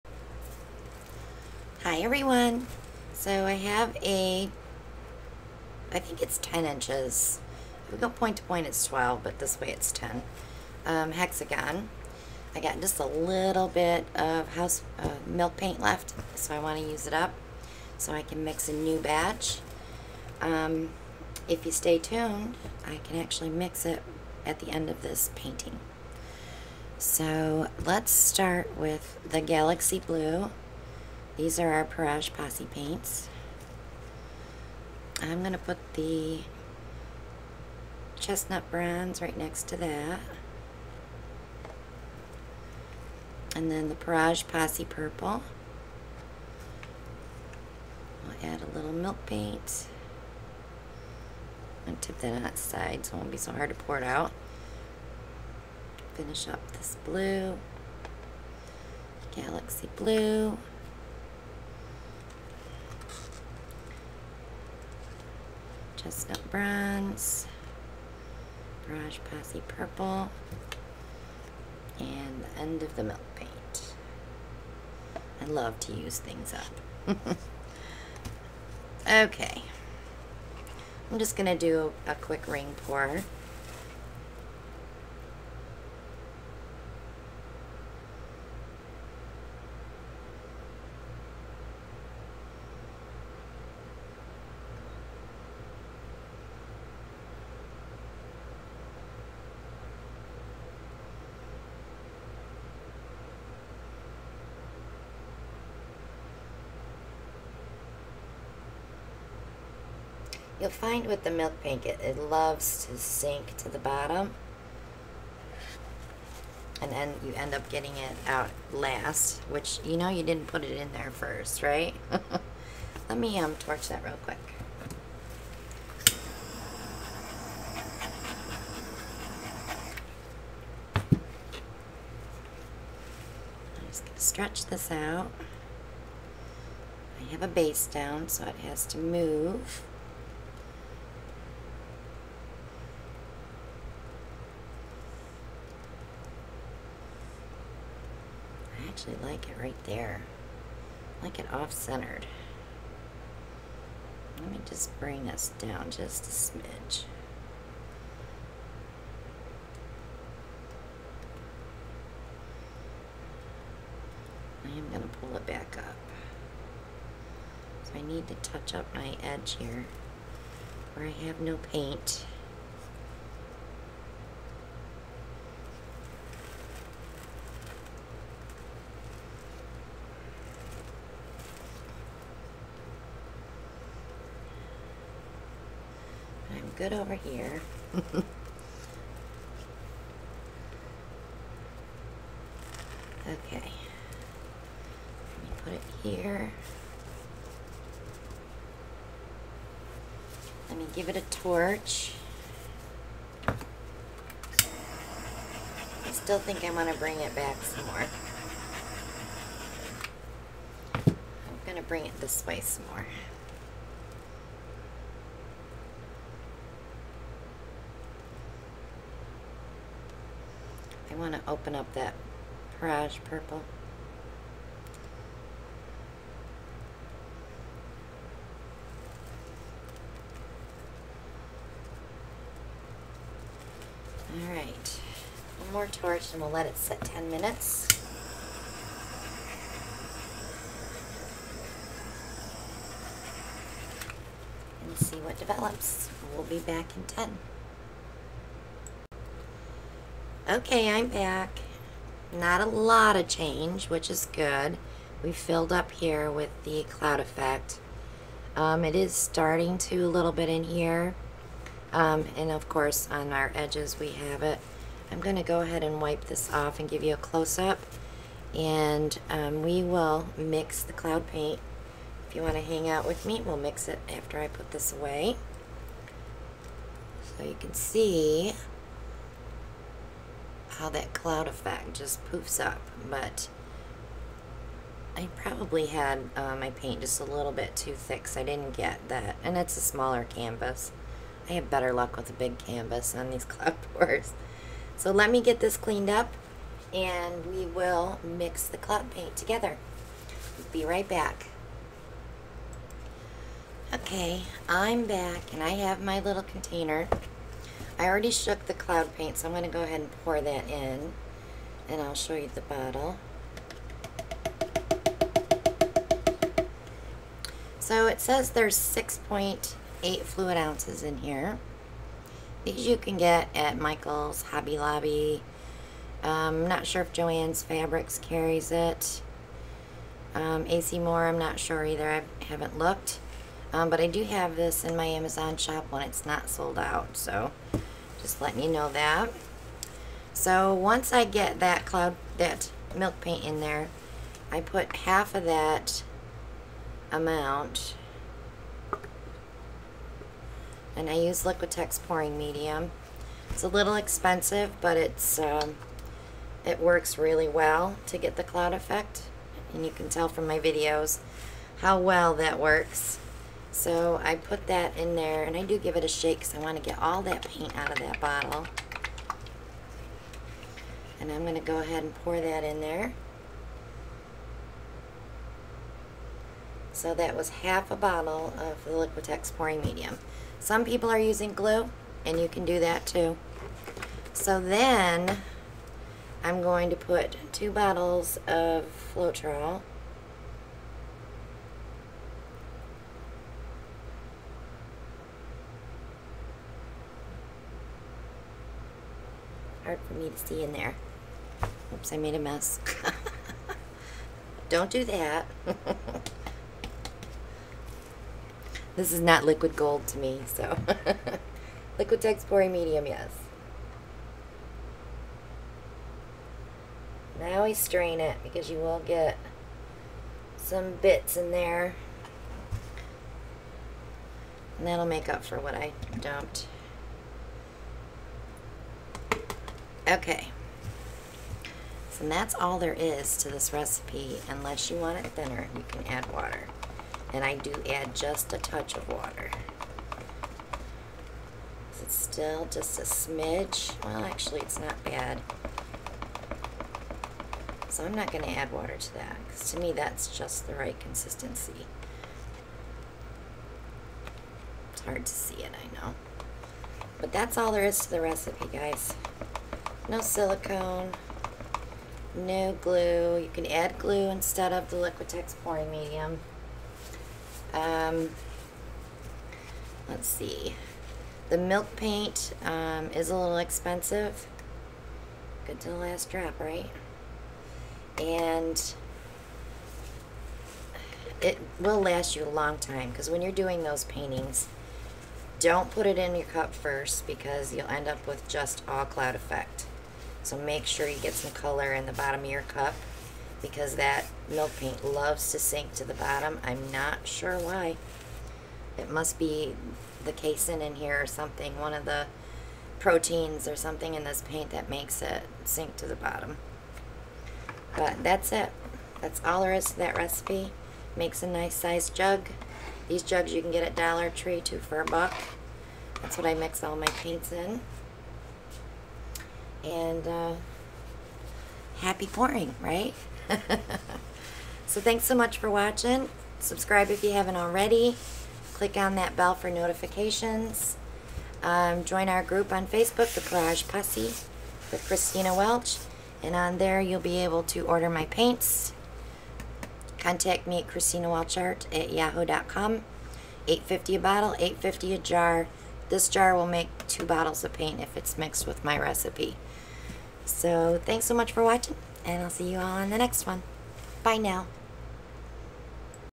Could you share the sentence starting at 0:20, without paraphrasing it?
Um, if you stay tuned, I can actually mix it at the end of this painting.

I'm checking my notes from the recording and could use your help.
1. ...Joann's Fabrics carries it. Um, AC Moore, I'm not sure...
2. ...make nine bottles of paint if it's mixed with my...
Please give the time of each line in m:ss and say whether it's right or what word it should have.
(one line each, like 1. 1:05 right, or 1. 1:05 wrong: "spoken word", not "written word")
1. 5:27 right
2. 9:06 wrong: "two", not "nine".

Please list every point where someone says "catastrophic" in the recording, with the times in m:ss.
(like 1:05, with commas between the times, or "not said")
not said.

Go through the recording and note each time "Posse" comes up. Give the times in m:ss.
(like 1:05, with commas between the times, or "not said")
0:32, 0:44, 1:09, 8:53.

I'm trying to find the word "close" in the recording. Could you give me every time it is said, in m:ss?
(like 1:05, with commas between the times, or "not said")
4:27.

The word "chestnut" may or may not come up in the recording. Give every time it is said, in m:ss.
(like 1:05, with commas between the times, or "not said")
0:38, 1:06.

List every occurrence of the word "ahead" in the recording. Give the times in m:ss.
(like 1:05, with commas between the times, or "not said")
4:25, 5:09, 6:11.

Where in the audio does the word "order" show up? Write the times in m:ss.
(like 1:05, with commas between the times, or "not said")
8:57.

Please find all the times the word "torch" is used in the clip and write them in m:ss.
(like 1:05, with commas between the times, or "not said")
2:03, 3:21, 3:55.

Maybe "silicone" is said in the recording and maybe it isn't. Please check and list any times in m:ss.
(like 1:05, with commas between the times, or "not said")
7:40.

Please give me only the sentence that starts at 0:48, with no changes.
I'll add a little milk paint.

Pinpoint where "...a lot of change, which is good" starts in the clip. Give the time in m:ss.
4:12.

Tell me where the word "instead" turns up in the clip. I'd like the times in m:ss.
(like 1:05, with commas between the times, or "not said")
7:44.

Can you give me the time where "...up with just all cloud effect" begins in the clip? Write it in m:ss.
8:08.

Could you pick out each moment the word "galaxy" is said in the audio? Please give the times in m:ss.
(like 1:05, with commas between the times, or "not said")
0:29, 0:59.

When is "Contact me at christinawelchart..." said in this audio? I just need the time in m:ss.
9:00.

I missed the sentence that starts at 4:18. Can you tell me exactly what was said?
Um, it is starting to a little bit in here.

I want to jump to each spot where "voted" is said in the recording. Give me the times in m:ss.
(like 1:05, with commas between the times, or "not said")
not said.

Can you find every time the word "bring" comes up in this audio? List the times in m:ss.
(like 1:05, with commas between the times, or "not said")
2:34, 3:26, 3:31.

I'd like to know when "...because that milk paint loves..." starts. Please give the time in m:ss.
8:13.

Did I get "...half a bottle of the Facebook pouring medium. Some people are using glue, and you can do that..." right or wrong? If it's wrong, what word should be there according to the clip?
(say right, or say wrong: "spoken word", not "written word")
wrong: "Liquitex", not "Facebook".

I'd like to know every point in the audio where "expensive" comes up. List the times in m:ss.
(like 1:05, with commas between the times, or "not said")
5:53, 7:53.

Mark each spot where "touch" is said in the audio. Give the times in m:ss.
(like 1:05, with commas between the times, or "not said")
2:48, 7:18.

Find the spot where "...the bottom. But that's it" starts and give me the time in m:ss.
8:26.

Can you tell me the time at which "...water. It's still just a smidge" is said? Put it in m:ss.
7:19.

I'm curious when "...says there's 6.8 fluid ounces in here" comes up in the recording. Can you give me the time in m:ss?
5:18.